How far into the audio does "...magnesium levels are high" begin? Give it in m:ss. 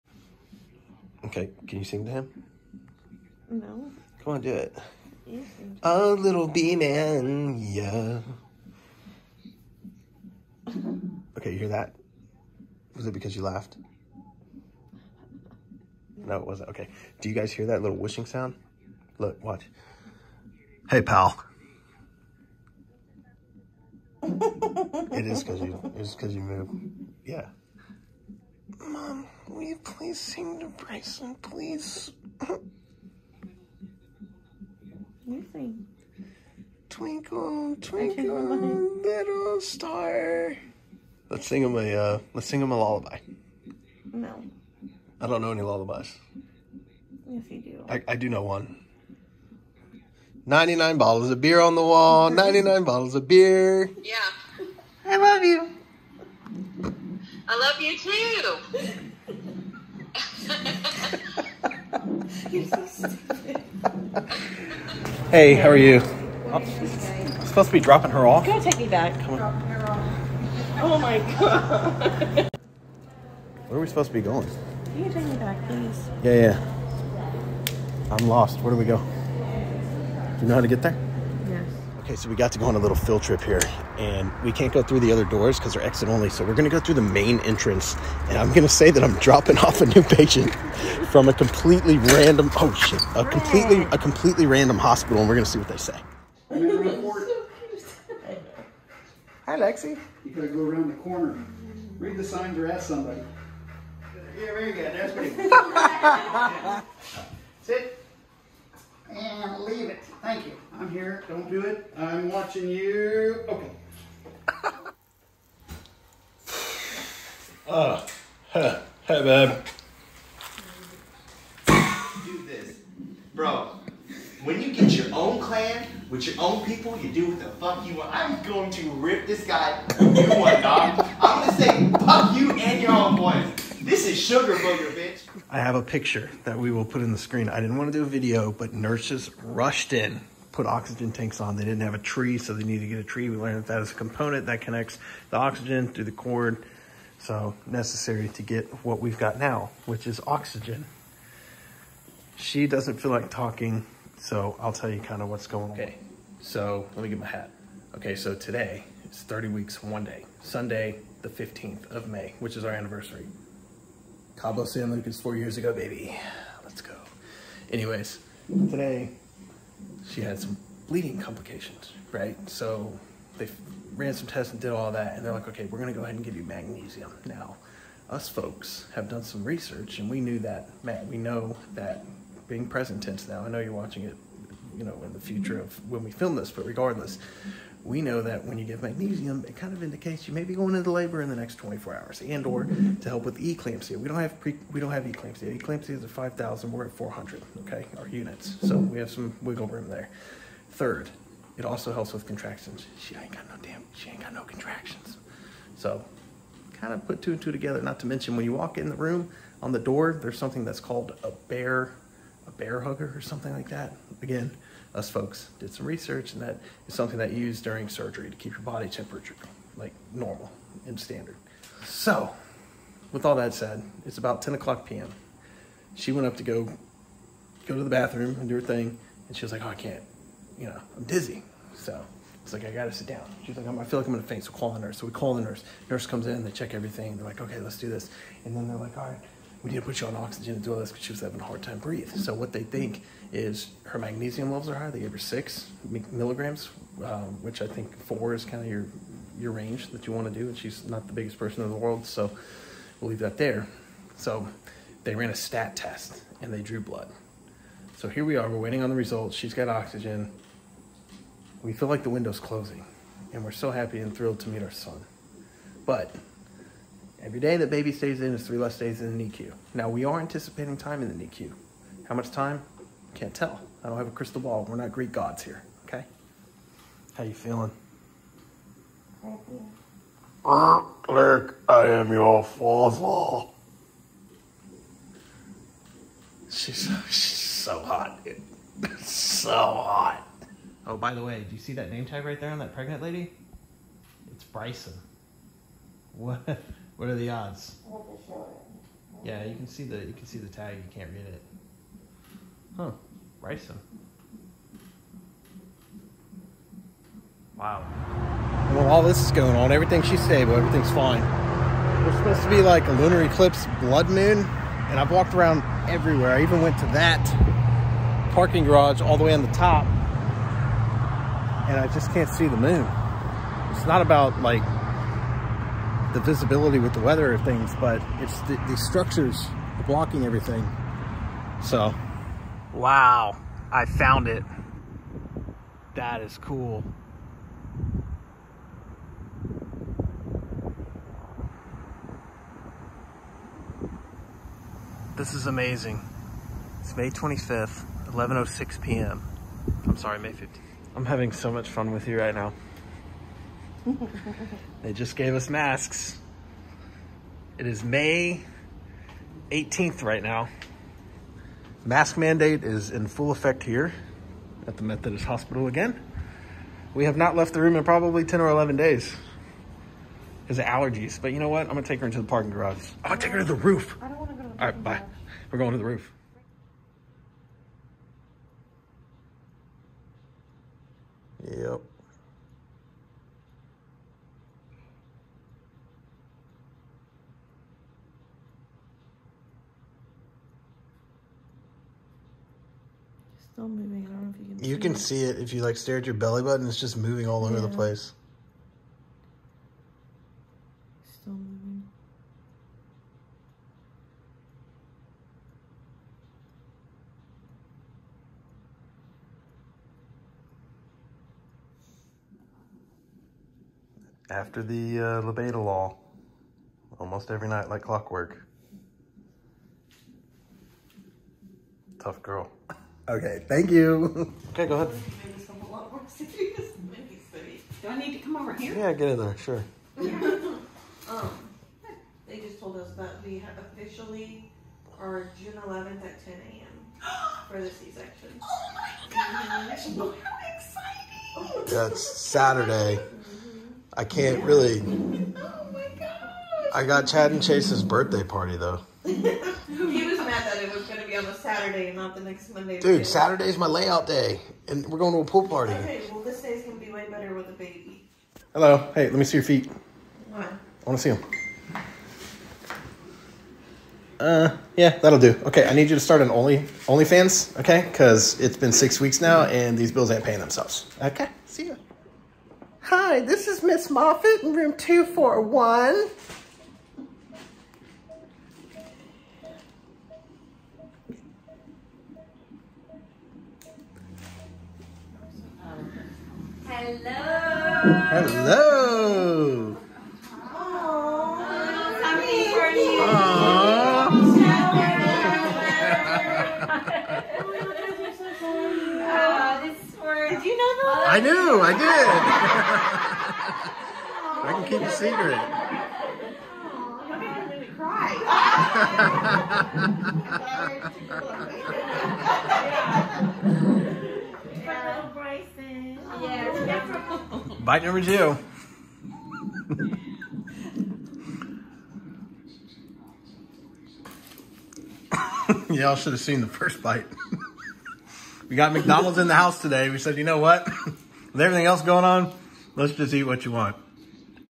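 4:03.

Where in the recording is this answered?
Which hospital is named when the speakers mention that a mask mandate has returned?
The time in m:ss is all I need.
6:04.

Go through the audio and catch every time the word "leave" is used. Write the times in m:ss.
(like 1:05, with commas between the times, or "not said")
1:49, 4:13.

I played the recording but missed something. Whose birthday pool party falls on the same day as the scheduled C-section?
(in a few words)
Chad and Chase.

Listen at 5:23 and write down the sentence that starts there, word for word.
It's not about like the visibility with the weather of things, but it's the, the structures blocking everything.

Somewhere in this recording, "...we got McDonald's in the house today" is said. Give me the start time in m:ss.
8:48.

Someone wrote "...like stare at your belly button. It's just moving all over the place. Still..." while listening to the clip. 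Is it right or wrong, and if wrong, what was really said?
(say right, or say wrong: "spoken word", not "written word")
right.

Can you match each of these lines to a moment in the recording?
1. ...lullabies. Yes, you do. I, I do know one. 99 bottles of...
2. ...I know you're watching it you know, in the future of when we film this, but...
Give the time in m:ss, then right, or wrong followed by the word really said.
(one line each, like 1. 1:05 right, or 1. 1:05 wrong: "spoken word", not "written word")
1. 0:45 right
2. 3:03 right.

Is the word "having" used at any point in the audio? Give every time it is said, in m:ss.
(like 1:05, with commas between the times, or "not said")
4:01, 5:51.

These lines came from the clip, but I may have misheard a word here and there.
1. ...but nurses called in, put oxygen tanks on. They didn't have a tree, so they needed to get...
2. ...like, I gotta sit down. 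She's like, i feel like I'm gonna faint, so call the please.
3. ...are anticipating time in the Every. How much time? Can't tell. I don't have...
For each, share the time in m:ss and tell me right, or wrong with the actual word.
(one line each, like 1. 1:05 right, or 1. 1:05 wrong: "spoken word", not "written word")
1. 2:18 wrong: "rushed", not "called"
2. 3:52 wrong: "nurse", not "please"
3. 4:30 wrong: "NICU", not "Every".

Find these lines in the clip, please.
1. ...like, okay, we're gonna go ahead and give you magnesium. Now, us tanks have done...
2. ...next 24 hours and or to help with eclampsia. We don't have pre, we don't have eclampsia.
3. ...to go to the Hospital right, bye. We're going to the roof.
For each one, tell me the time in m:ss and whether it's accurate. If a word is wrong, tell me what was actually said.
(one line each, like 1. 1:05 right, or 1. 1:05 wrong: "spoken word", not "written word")
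1. 2:55 wrong: "folks", not "tanks"
2. 3:11 right
3. 6:14 wrong: "All", not "Hospital".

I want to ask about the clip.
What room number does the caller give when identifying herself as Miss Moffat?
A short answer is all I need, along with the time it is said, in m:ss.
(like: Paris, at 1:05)
241, at 7:54.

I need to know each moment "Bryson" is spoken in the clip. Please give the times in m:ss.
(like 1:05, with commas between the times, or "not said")
0:30, 4:54.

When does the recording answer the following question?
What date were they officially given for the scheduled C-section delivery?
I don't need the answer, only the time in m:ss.
7:15.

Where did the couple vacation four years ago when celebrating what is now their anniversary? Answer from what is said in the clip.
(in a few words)
Cabo San Lucas.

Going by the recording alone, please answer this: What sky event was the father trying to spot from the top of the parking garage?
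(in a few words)
lunar eclipse blood moon.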